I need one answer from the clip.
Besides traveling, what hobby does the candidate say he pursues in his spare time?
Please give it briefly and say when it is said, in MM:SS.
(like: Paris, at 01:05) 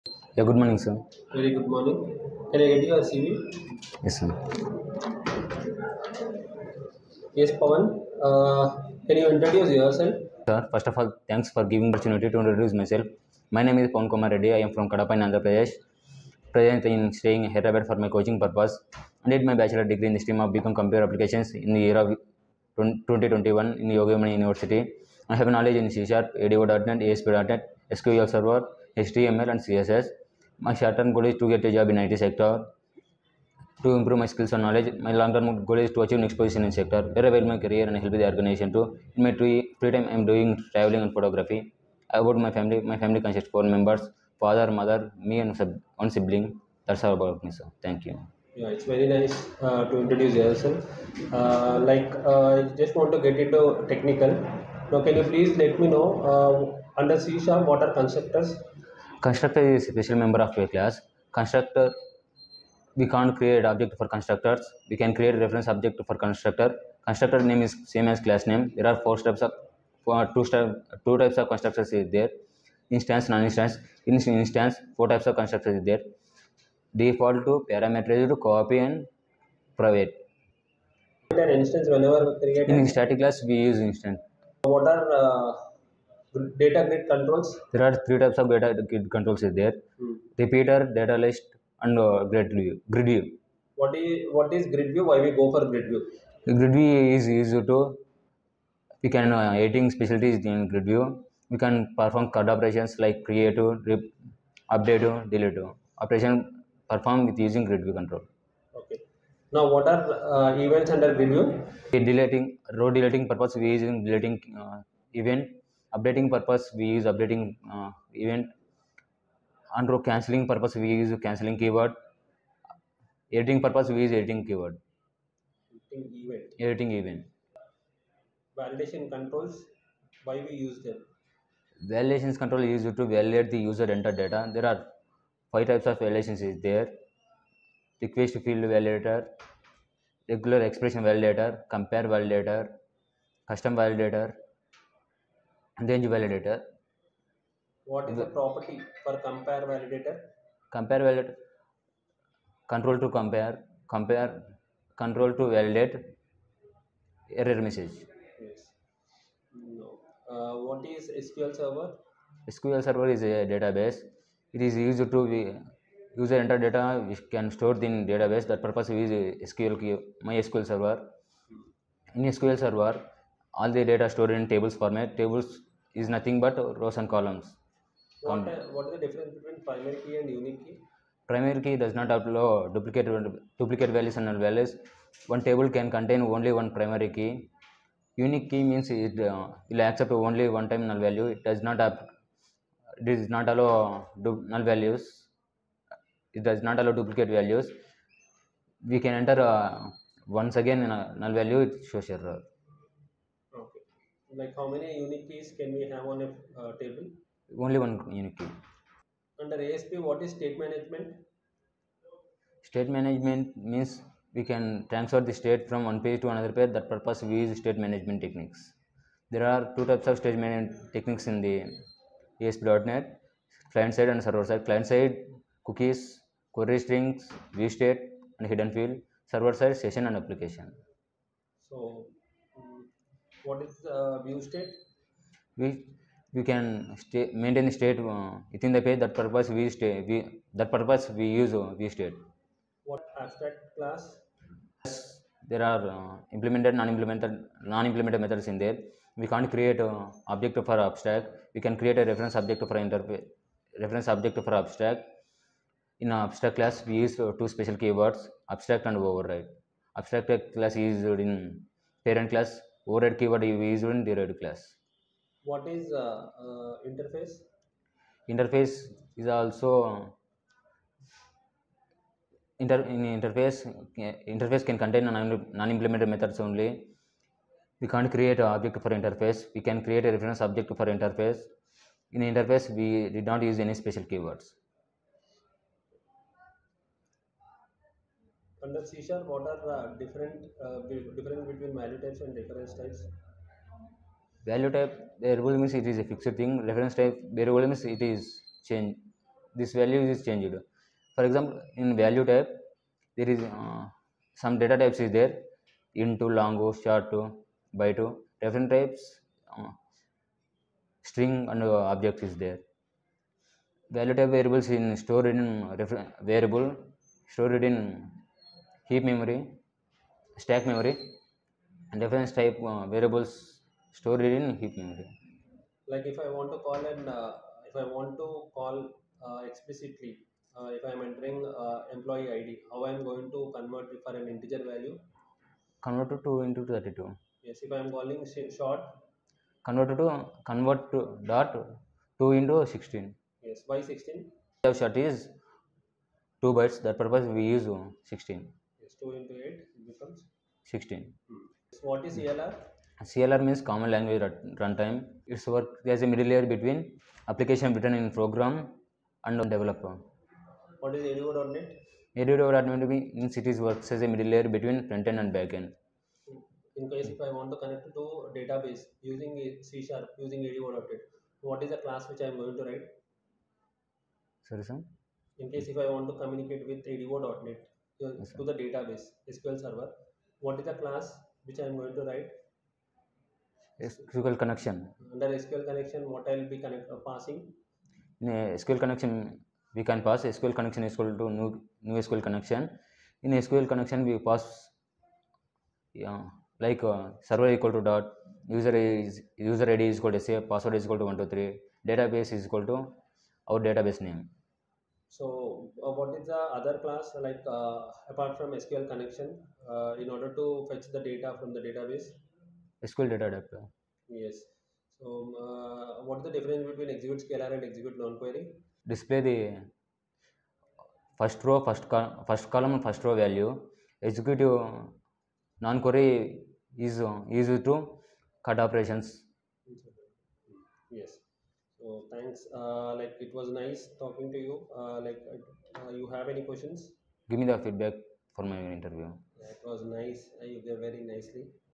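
Photography, at 00:41.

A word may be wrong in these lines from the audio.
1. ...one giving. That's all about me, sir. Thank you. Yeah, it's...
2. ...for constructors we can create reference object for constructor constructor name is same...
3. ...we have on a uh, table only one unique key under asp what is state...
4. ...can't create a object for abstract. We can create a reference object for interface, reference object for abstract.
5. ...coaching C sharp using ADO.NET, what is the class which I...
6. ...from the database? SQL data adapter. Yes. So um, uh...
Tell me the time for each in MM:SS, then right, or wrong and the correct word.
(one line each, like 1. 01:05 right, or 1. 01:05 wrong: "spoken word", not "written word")
1. 00:46 wrong: "sibling", not "giving"
2. 01:03 right
3. 03:25 right
4. 04:09 right
5. 06:09 wrong: "using", not "coaching"
6. 06:51 right.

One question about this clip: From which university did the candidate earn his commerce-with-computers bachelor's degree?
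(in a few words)
Yogi Vemana University.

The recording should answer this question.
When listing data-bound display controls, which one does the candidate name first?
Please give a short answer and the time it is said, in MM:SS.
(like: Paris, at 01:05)
Repeater, at 01:30.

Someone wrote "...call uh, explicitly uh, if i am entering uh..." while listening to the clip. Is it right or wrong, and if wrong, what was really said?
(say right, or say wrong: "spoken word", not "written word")
right.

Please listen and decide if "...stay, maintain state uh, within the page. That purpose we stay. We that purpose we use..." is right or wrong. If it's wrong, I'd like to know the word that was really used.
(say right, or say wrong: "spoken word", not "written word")
right.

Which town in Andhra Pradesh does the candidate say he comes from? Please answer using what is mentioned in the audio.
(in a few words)
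Kadapa.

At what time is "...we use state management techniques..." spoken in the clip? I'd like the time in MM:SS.
03:37.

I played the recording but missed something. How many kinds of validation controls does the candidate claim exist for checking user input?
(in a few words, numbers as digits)
5.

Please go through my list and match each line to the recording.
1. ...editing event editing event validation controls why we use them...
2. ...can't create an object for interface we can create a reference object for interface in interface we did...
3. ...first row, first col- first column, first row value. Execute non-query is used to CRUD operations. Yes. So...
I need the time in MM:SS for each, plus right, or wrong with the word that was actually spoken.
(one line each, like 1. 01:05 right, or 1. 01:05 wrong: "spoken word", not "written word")
1. 02:05 right
2. 04:37 right
3. 07:01 right.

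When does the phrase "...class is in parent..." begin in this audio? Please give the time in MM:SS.
04:20.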